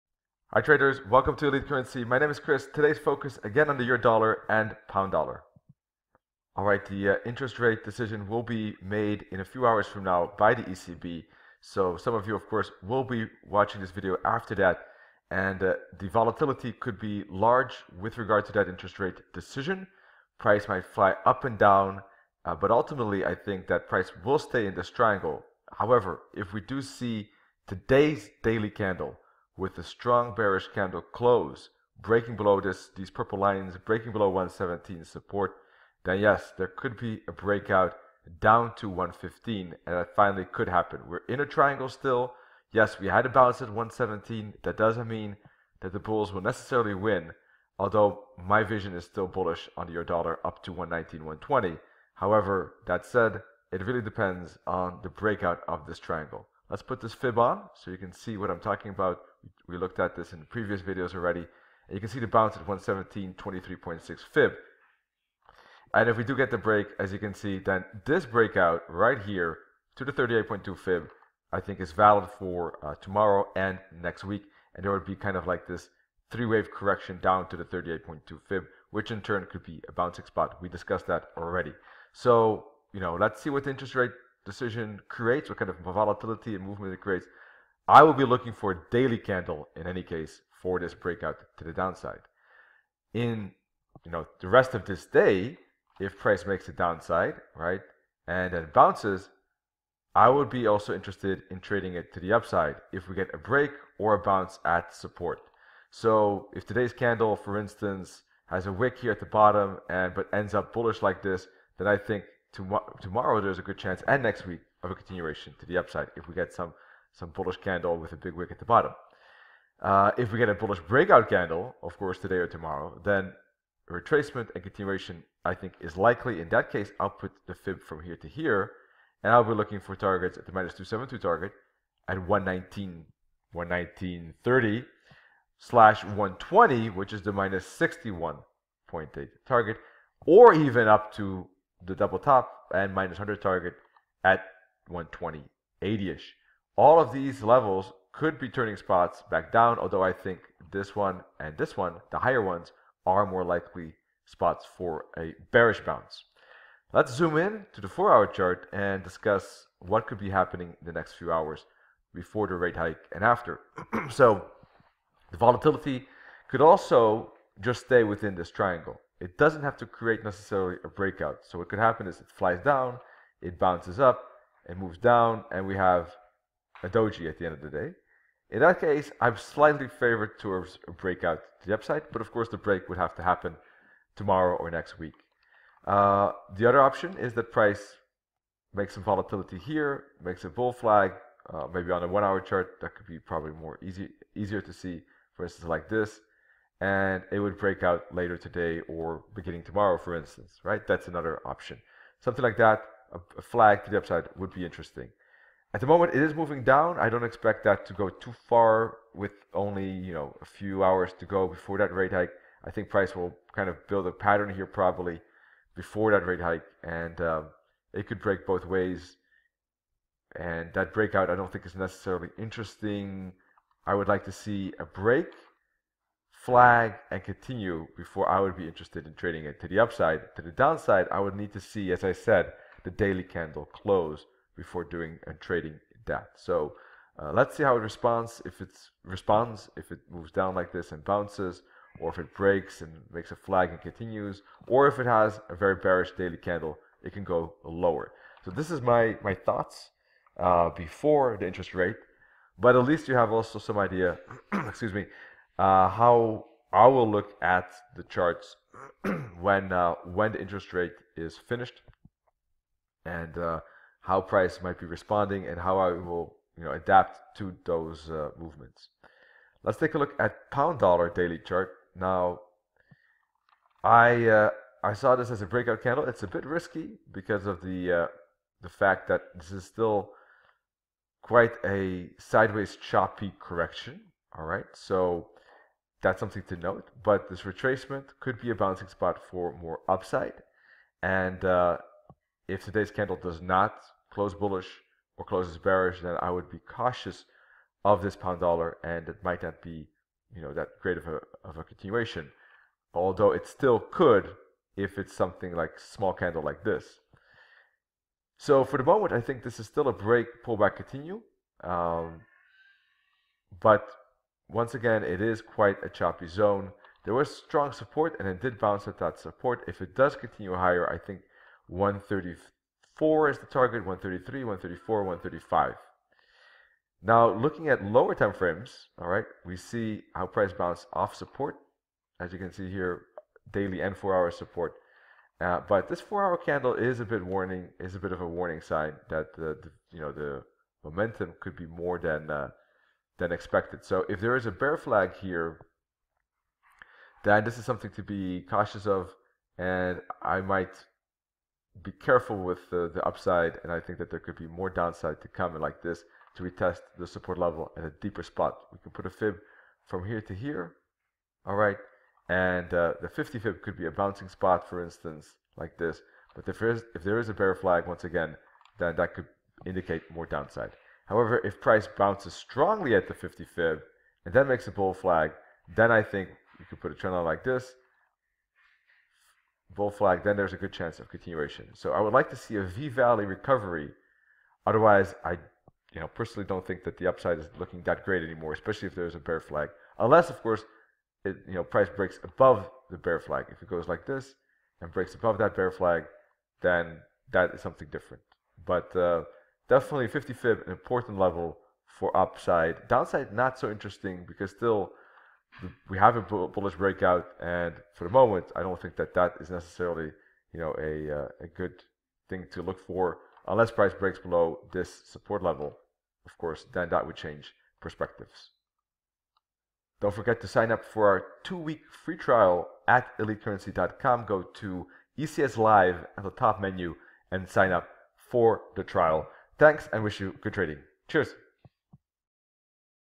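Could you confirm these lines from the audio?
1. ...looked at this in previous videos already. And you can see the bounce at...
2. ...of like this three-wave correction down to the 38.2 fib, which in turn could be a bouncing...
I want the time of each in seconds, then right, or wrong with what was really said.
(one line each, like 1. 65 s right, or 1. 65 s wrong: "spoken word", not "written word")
1. 59 s right
2. 75 s right.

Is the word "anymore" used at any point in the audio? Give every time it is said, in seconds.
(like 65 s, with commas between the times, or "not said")
388 s.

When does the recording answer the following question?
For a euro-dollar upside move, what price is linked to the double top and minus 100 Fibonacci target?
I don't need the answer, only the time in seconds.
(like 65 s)
144 s.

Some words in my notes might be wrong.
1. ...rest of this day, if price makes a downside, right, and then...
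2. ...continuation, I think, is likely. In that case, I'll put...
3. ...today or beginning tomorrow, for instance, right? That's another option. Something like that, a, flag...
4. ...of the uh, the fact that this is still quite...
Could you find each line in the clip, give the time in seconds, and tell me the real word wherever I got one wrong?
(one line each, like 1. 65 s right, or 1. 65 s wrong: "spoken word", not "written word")
1. 94 s right
2. 124 s right
3. 198 s right
4. 277 s right.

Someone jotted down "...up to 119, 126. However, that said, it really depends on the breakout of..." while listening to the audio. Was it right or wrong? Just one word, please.
wrong.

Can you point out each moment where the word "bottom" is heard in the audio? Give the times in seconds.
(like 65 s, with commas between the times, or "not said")
109 s, 118 s.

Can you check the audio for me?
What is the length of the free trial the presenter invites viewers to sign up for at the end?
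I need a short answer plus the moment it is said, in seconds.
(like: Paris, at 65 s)
two-week, at 421 s.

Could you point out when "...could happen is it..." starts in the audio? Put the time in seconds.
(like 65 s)
171 s.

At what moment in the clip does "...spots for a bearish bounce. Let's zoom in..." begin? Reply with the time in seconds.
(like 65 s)
154 s.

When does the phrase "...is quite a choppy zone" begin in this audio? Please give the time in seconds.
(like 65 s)
315 s.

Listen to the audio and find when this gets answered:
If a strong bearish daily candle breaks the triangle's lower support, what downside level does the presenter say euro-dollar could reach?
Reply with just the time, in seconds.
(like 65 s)
38 s.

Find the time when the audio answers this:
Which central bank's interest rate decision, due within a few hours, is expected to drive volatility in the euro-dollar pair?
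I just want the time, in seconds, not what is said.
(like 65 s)
10 s.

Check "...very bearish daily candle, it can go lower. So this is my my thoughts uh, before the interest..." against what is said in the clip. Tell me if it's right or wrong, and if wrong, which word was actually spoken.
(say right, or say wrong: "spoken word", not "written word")
right.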